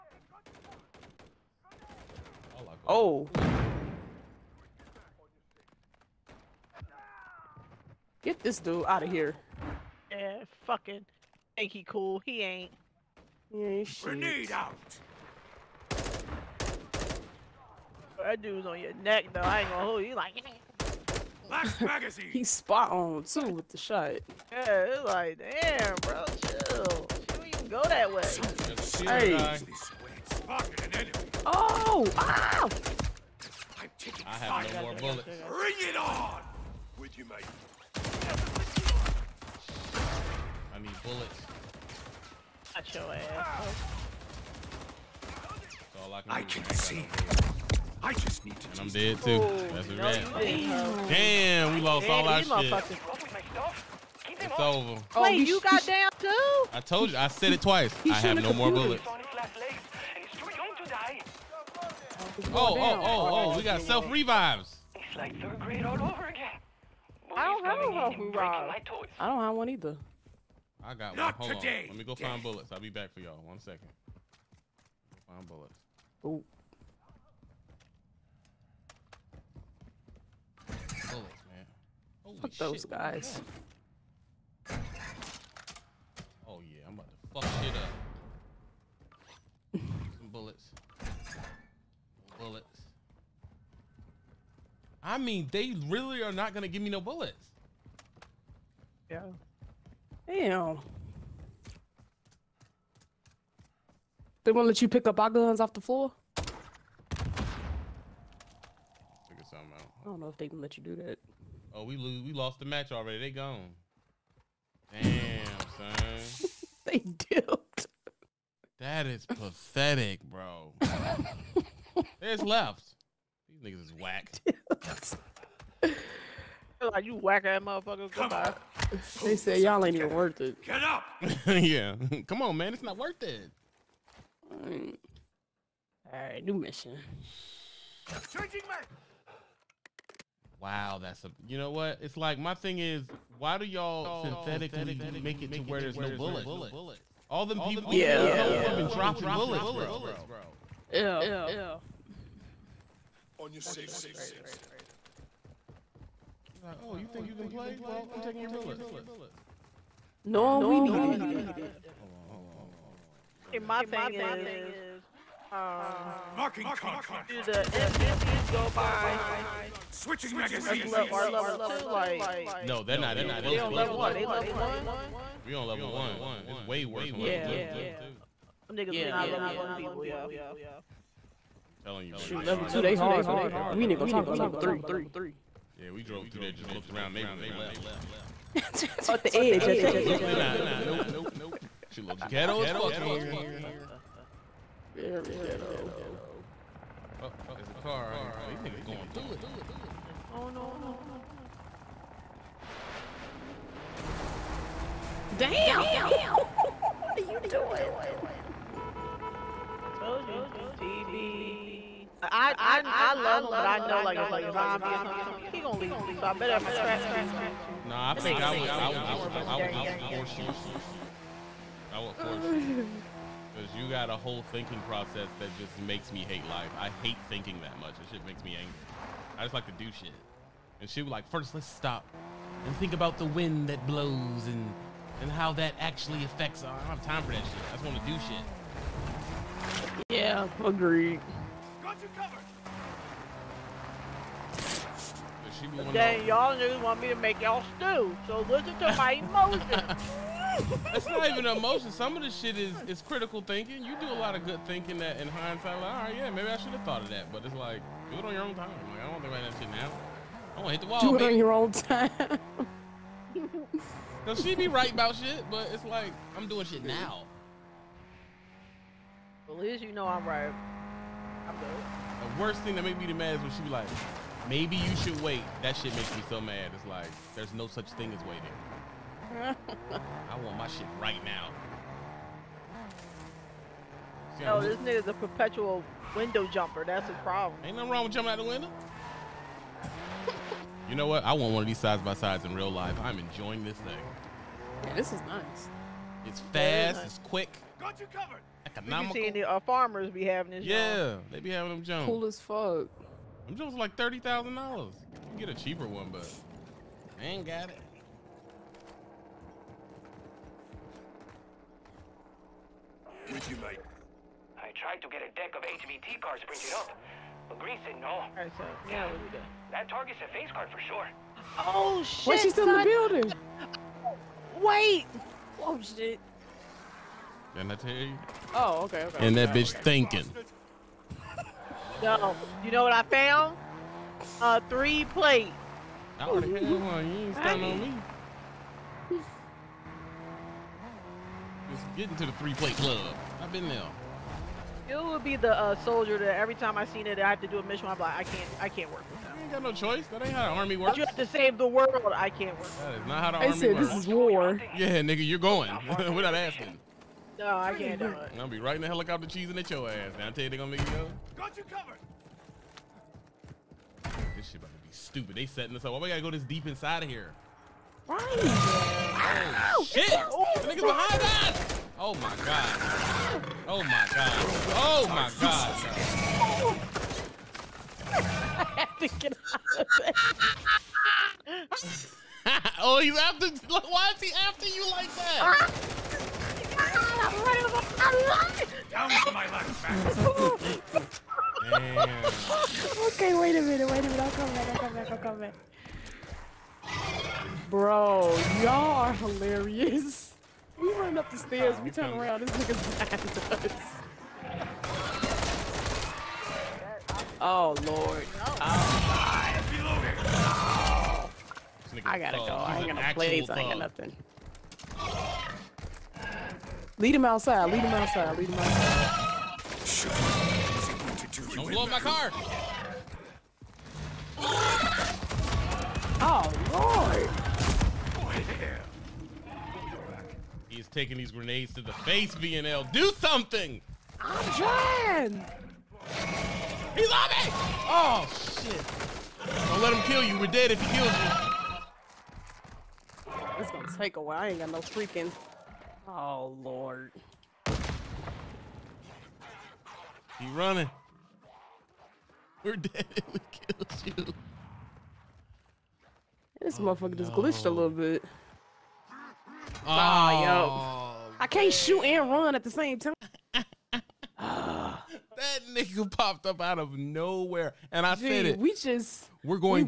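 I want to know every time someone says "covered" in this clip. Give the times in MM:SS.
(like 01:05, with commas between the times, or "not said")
04:58, 06:01.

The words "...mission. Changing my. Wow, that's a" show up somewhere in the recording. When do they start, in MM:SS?
02:16.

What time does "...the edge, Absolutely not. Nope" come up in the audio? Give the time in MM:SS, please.
03:09.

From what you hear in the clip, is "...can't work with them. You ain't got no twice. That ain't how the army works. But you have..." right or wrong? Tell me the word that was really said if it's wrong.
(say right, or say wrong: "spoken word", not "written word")
wrong: "choice", not "twice".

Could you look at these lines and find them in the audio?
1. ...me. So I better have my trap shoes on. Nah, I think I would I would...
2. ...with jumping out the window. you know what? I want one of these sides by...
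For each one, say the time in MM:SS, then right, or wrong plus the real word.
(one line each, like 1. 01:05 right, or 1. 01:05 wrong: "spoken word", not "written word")
1. 03:35 right
2. 04:48 right.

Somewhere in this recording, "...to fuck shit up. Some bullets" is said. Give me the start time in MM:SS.
01:27.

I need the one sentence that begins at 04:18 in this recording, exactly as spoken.
Like, I don't think about that shit now.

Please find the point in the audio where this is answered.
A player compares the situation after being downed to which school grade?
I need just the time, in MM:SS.
01:05.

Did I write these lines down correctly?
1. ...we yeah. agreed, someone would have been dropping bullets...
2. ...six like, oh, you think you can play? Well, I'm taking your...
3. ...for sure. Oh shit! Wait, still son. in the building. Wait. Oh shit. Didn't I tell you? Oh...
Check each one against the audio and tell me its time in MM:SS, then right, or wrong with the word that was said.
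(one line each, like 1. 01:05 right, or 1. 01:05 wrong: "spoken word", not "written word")
1. 02:27 wrong: "killed", not "agreed"
2. 02:33 right
3. 05:20 right.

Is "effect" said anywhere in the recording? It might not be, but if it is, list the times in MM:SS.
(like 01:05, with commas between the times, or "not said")
not said.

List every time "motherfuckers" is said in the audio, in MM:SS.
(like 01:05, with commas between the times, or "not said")
02:07, 07:36.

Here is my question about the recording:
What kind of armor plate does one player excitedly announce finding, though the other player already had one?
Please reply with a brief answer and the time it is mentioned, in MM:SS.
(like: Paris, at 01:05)
A three plate, at 05:34.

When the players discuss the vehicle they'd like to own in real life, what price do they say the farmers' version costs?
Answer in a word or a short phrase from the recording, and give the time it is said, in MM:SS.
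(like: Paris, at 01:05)
$30,000, at 05:03.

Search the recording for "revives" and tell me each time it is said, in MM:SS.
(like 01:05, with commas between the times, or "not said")
01:04, 01:08.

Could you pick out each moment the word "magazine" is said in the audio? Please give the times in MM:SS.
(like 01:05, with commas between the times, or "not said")
00:21, 02:50.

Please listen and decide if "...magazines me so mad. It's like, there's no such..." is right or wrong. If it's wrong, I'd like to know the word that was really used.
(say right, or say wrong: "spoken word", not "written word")
wrong: "makes", not "magazines".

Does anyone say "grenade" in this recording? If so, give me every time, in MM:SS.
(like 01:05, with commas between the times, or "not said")
00:14, 07:11.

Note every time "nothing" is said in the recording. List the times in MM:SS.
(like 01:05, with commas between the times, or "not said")
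04:47, 06:53.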